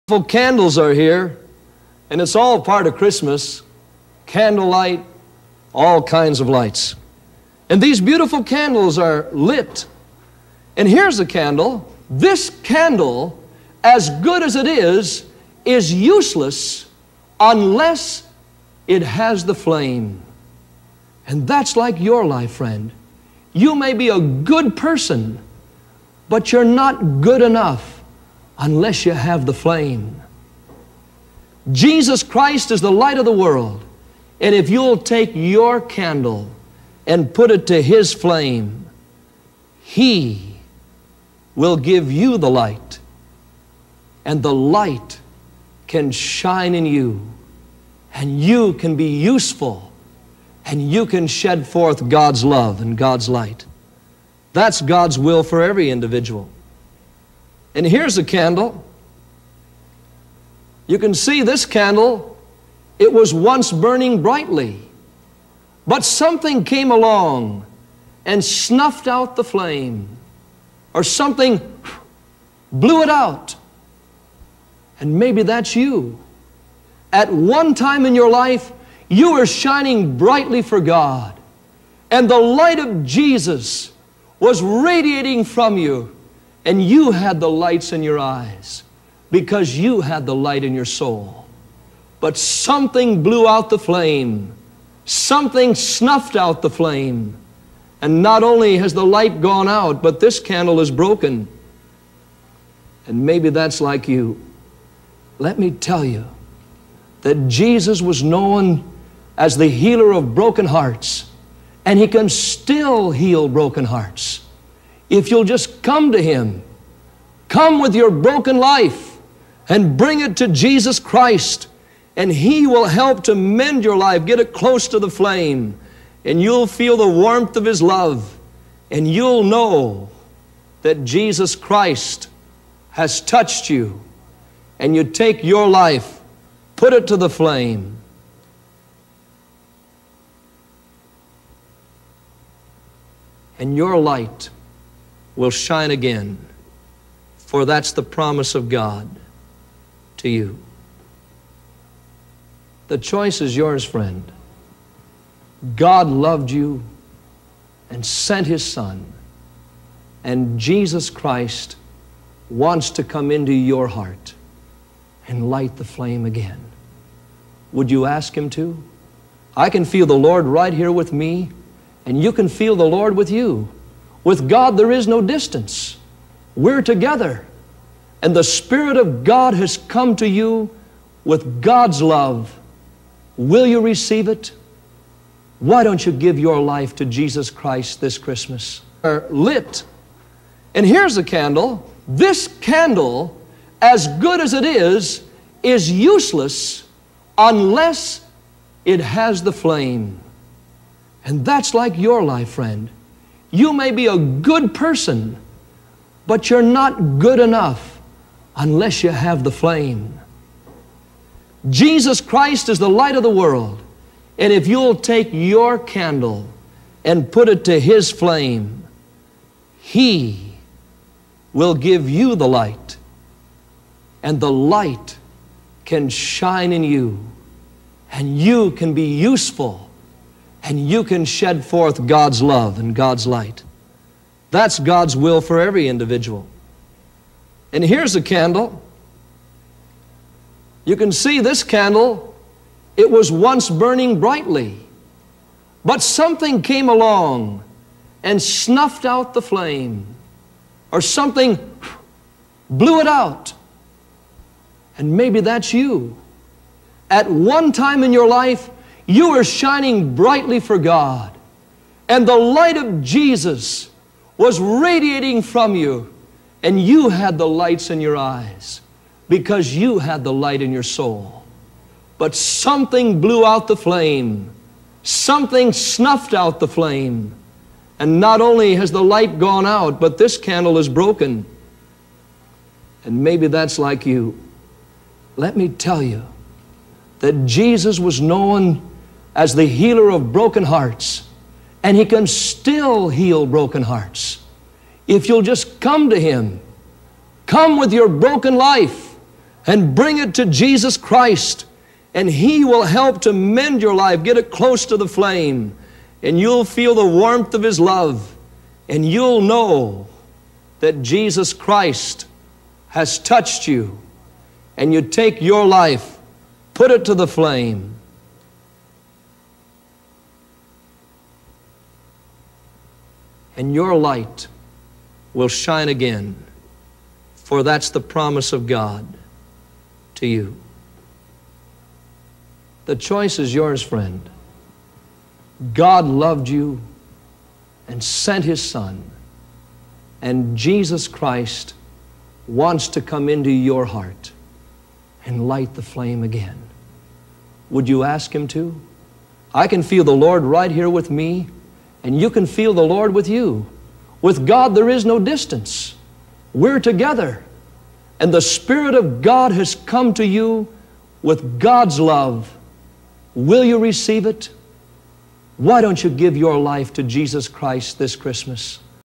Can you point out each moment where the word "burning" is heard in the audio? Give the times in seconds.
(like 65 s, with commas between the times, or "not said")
63 s, 243 s.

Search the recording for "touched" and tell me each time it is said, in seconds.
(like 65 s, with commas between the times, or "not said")
133 s, 313 s.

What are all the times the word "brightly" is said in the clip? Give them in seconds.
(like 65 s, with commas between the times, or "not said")
64 s, 80 s, 244 s, 260 s.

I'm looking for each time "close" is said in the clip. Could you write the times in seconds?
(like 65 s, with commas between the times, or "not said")
124 s, 304 s.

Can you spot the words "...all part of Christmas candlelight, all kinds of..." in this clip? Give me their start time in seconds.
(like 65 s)
2 s.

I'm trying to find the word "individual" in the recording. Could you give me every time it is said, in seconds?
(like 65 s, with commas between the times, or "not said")
55 s, 235 s.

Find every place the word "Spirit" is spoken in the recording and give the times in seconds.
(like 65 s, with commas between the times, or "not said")
178 s, 358 s.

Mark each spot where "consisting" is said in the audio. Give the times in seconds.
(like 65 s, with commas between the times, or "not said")
not said.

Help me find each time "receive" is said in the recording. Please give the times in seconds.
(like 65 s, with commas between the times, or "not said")
183 s, 363 s.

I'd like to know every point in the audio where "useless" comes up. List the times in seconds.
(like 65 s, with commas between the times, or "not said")
15 s, 195 s.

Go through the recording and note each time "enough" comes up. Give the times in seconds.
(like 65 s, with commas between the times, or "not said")
27 s, 207 s.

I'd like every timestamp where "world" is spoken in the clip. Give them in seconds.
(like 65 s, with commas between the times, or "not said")
33 s, 213 s.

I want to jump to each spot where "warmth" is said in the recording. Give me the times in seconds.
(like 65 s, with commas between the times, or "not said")
127 s, 307 s.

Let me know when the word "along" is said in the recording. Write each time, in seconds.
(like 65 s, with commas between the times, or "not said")
66 s, 246 s.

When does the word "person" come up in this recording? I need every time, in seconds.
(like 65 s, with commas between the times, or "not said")
24 s, 204 s.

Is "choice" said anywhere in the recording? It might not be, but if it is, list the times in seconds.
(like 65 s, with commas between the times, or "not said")
152 s, 332 s.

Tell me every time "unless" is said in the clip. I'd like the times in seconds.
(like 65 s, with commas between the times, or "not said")
17 s, 28 s, 197 s, 208 s.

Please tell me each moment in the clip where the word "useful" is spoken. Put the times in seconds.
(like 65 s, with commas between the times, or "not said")
49 s, 229 s.